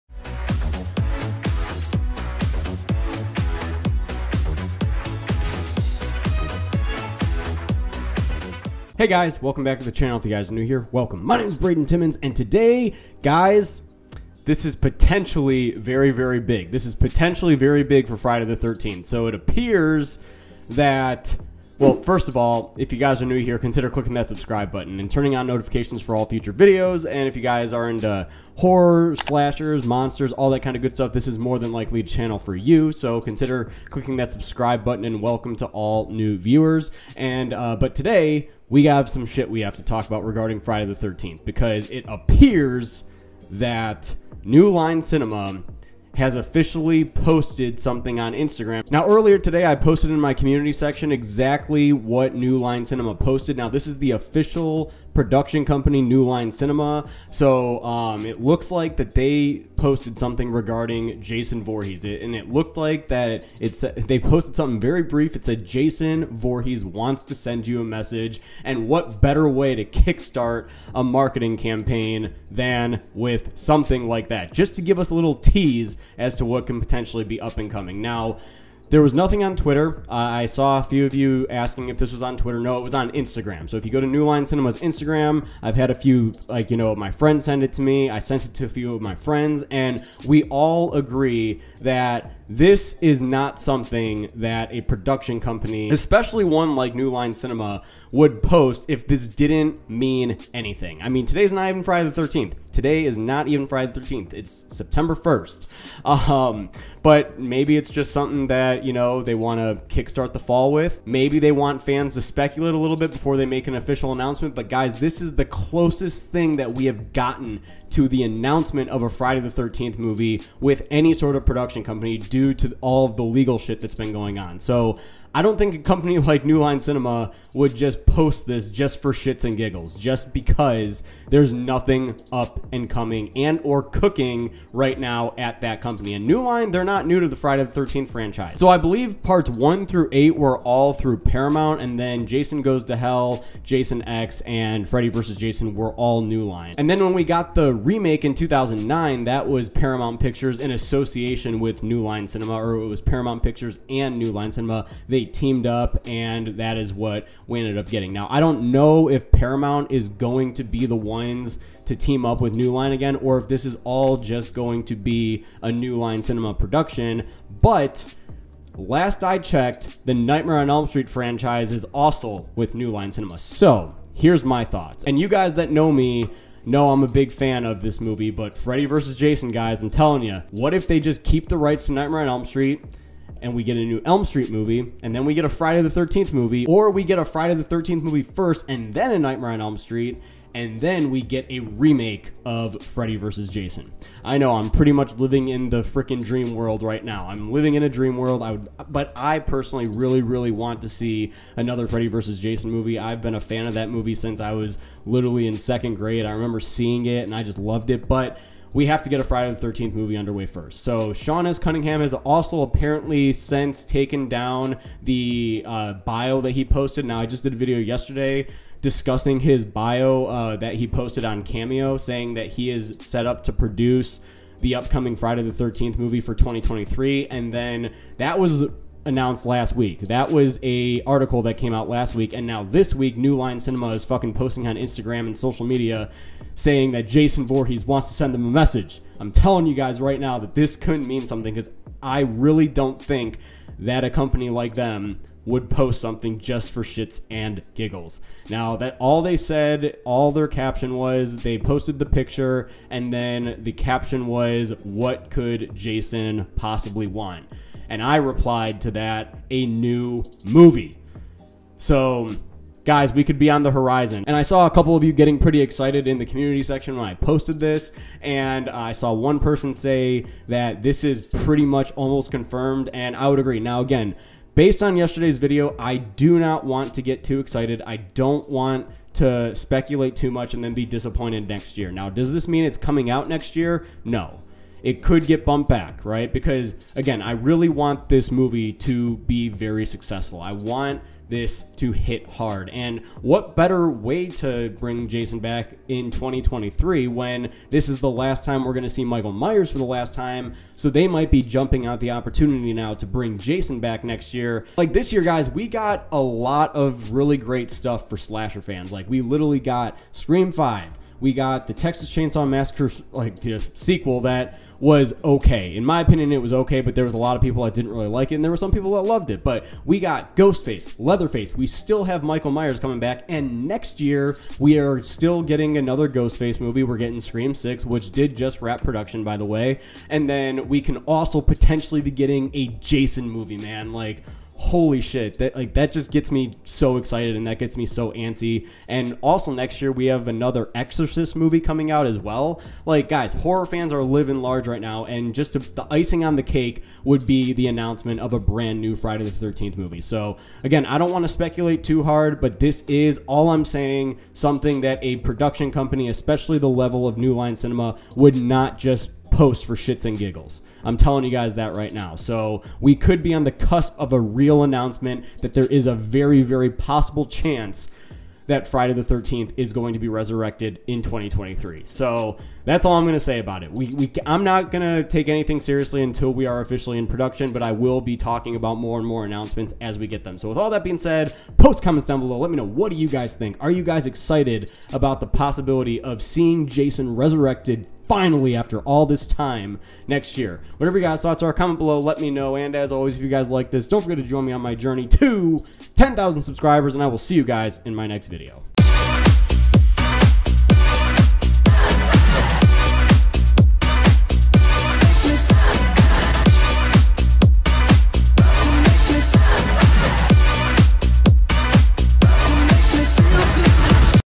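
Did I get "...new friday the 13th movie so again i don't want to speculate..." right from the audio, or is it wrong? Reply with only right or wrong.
right.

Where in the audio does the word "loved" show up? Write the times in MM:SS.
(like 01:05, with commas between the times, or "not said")
03:27, 05:19.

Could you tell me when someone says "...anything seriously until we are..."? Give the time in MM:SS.
06:15.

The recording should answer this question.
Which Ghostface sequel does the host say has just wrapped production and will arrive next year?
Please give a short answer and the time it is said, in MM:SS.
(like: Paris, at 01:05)
Scream 6, at 05:27.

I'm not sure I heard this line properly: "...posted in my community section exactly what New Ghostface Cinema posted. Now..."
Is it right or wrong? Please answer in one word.
wrong.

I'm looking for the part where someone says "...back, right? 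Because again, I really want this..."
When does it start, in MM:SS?
04:45.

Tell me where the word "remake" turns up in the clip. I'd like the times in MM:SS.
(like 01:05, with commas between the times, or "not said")
02:27, 03:11.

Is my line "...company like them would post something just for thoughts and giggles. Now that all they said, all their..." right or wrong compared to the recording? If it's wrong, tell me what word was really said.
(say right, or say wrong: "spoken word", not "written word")
wrong: "shits", not "thoughts".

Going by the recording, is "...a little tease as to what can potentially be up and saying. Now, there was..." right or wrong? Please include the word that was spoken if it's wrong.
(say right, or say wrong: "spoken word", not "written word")
wrong: "coming", not "saying".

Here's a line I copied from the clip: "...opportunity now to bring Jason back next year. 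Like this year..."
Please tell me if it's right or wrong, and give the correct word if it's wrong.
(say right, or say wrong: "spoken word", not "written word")
right.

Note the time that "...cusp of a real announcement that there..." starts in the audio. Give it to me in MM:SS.
06:03.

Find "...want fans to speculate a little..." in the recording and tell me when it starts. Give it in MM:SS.
01:51.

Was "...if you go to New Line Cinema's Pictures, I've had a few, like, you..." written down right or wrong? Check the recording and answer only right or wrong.
wrong.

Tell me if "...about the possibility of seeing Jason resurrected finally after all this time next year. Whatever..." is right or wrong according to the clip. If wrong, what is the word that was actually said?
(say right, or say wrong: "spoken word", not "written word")
right.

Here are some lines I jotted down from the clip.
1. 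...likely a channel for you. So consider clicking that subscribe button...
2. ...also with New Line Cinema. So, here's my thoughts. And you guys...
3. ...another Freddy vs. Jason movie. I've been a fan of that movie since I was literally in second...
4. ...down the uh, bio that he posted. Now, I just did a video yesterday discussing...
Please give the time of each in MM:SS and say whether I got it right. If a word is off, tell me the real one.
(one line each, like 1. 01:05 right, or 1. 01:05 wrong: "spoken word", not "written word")
1. 00:31 right
2. 02:51 right
3. 03:21 right
4. 03:34 right.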